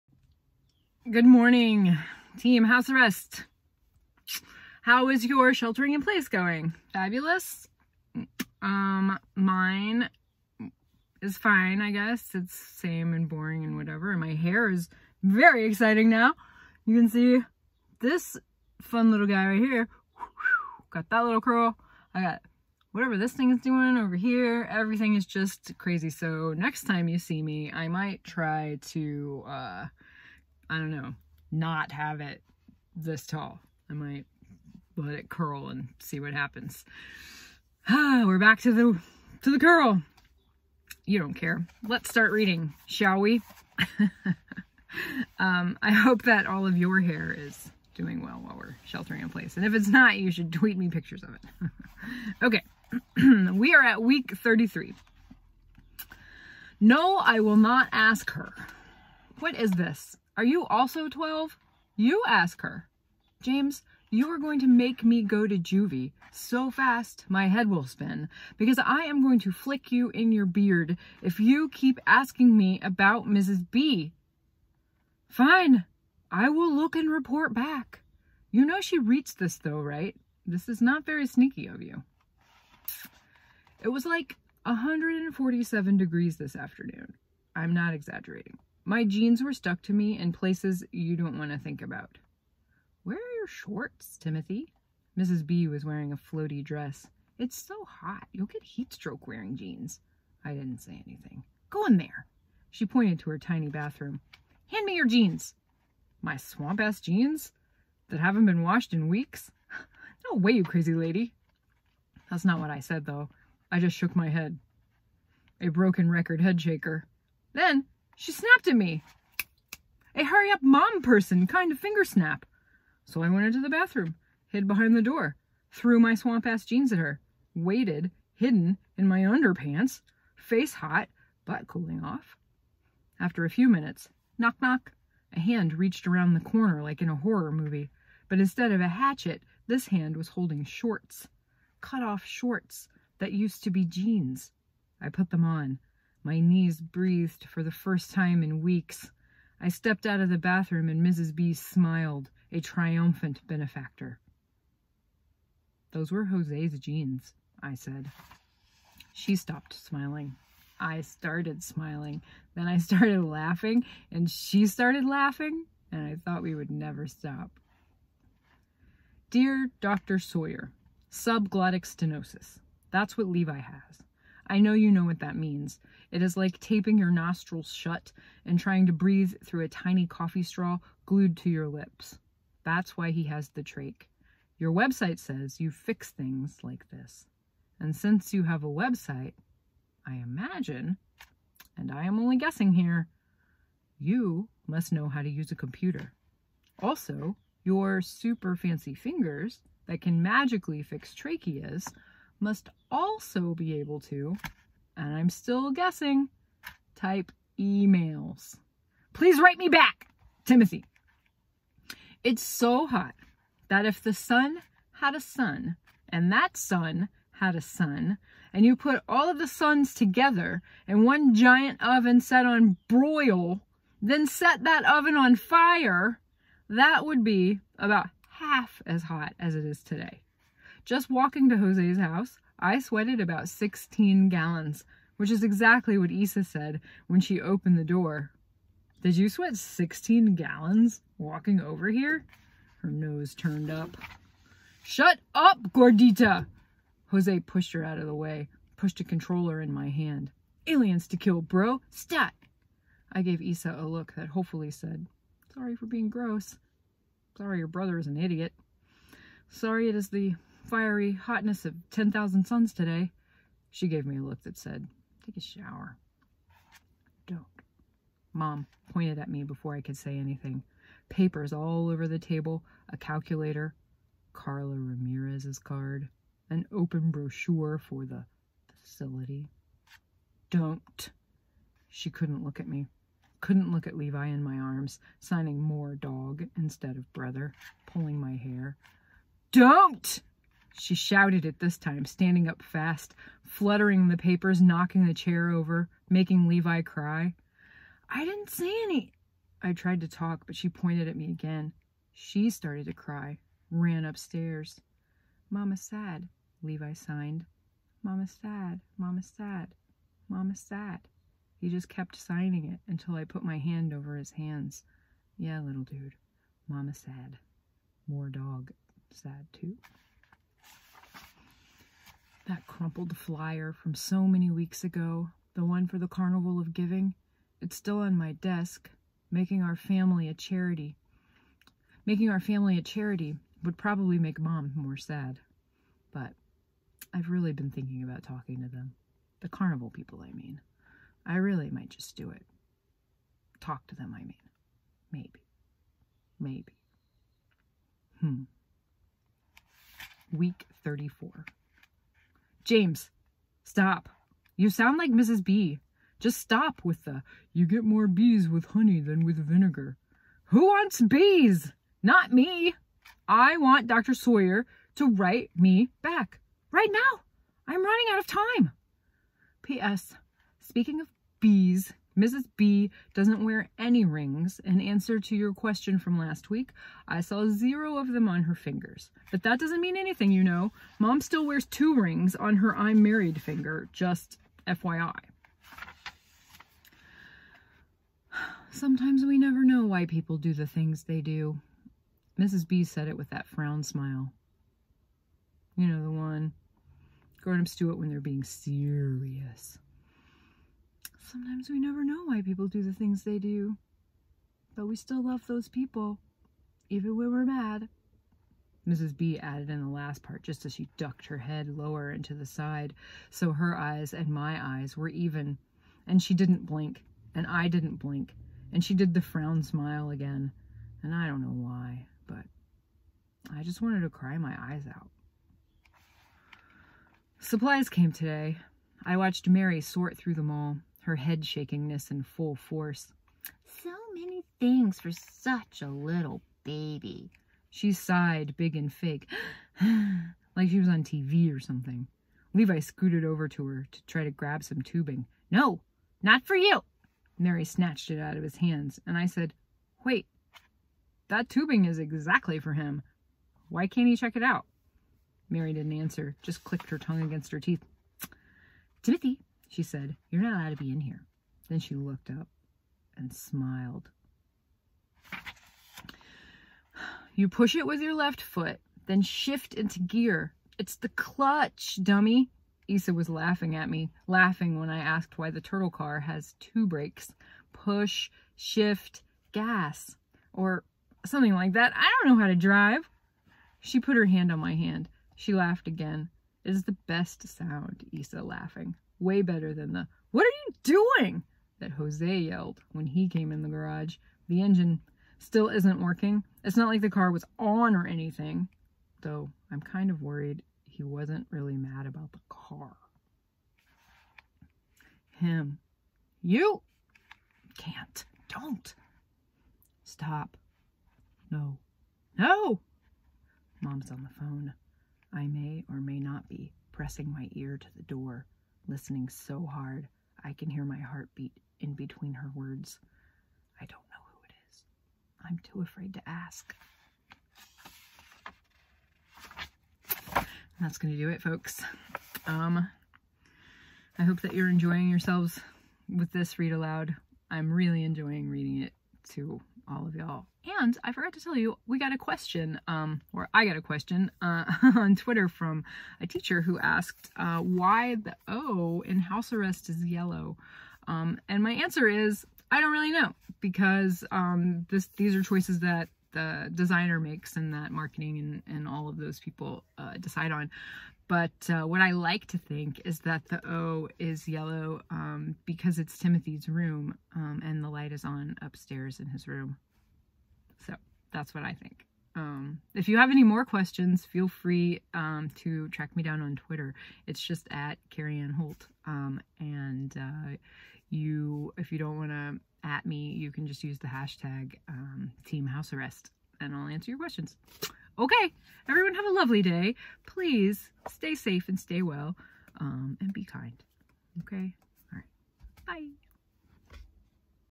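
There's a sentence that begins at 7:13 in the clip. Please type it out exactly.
So many things for such a little baby.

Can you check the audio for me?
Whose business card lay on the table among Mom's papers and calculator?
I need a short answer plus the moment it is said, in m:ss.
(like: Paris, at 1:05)
Carla Ramirez, at 4:34.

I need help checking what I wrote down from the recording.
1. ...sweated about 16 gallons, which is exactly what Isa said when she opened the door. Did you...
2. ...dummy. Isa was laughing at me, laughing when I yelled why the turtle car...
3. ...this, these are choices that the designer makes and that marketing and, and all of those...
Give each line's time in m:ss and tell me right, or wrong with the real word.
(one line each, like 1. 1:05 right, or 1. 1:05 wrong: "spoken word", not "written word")
1. 3:52 right
2. 7:52 wrong: "asked", not "yelled"
3. 9:14 right.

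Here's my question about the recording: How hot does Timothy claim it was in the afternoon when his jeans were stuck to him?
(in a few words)
147 degrees.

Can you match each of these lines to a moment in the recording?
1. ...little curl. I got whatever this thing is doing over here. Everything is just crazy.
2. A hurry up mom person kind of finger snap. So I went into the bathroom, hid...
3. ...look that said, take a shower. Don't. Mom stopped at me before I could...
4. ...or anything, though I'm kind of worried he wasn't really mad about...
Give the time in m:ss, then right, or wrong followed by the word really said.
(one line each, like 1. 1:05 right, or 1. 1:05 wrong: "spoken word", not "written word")
1. 0:21 right
2. 2:00 right
3. 4:24 wrong: "pointed", not "stopped"
4. 8:17 right.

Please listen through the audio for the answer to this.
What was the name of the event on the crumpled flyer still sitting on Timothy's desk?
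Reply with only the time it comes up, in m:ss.
5:26.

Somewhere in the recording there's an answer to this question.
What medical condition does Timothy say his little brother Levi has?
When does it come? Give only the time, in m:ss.
2:51.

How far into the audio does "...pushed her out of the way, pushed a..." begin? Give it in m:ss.
4:07.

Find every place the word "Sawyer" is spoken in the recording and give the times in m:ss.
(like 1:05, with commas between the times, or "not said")
2:50, 6:04.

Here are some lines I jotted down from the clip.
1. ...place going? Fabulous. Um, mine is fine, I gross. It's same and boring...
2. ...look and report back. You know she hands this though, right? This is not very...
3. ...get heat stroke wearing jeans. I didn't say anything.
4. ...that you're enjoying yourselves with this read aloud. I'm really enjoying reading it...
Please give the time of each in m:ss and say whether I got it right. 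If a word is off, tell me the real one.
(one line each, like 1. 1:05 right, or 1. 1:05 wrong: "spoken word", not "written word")
1. 0:06 wrong: "guess", not "gross"
2. 1:16 wrong: "reads", not "hands"
3. 1:38 right
4. 8:54 right.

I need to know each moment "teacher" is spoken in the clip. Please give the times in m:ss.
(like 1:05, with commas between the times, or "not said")
9:06.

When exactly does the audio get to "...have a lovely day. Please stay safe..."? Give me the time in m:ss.
9:49.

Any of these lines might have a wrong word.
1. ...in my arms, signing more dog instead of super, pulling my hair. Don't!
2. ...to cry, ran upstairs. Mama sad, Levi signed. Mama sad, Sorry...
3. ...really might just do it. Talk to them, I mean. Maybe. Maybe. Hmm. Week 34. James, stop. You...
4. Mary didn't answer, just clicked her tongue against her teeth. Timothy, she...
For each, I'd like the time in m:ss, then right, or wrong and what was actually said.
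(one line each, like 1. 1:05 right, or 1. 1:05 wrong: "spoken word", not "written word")
1. 4:44 wrong: "brother", not "super"
2. 5:02 wrong: "Mama", not "Sorry"
3. 5:41 right
4. 7:35 right.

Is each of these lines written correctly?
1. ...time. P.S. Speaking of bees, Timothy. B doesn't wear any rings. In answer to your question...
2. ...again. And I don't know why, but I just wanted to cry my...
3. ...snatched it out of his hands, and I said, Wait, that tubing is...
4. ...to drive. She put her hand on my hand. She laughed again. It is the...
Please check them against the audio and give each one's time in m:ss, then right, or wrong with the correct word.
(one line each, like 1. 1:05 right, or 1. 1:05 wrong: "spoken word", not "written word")
1. 6:08 wrong: "Mrs", not "Timothy"
2. 7:00 right
3. 7:27 right
4. 8:02 right.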